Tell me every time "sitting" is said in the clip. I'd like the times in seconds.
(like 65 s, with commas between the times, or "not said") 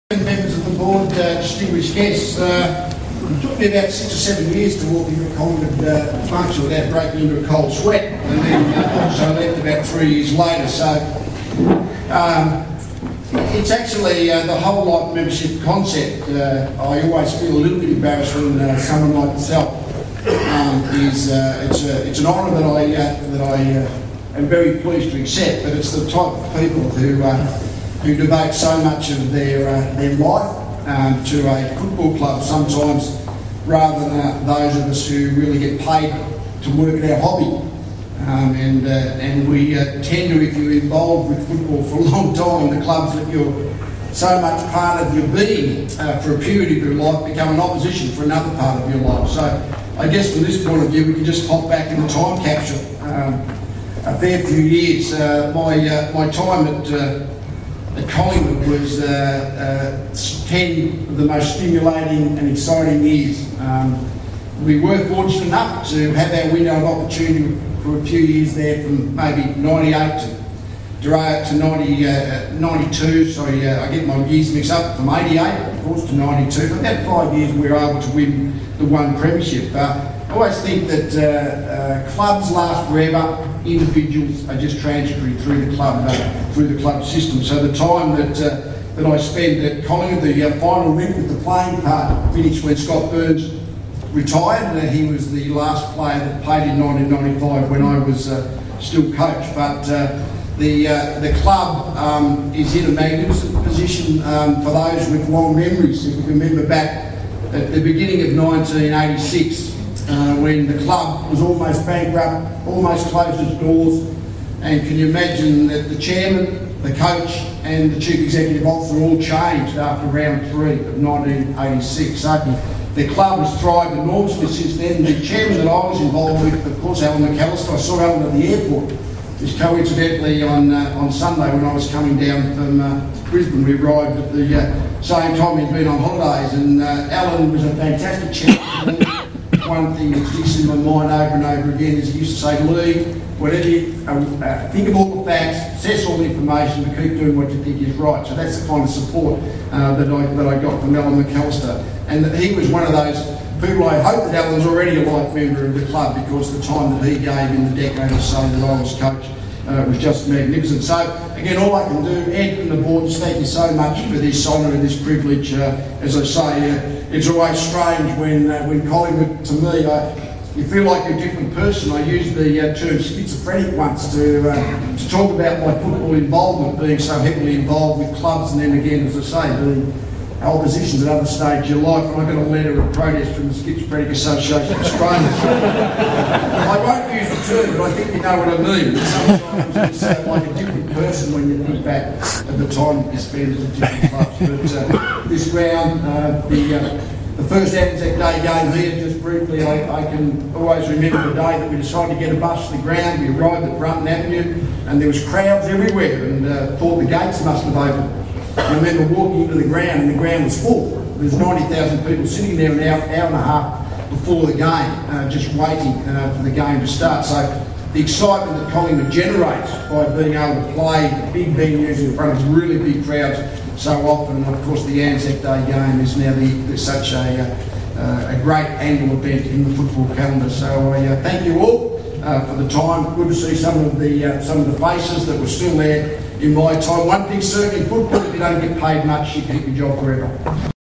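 212 s.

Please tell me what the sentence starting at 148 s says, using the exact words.
So that's the kind of support uh, that, I, that I got from Alan McAlister.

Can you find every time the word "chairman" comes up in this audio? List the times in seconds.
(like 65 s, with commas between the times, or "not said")
115 s, 125 s, 138 s.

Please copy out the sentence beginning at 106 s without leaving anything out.
If you remember back at the beginning of 1986.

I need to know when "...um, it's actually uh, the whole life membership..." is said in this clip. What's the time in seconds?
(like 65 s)
12 s.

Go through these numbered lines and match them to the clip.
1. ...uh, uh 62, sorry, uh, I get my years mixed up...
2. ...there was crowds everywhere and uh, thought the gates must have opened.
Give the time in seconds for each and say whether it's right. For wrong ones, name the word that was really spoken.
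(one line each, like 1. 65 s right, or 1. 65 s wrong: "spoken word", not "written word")
1. 72 s wrong: "92", not "62"
2. 204 s right.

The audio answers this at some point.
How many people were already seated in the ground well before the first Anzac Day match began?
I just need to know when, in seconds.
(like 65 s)
211 s.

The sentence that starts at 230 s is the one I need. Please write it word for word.
So I uh, thank you all uh, for the time.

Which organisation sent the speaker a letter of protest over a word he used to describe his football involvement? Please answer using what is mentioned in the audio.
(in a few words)
Schizophrenic Association of Australia.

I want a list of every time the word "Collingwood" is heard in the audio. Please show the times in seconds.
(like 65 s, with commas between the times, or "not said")
58 s, 89 s, 168 s, 218 s.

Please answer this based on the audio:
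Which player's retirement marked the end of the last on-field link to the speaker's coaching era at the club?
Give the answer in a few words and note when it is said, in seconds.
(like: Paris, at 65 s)
Scott Burns, at 92 s.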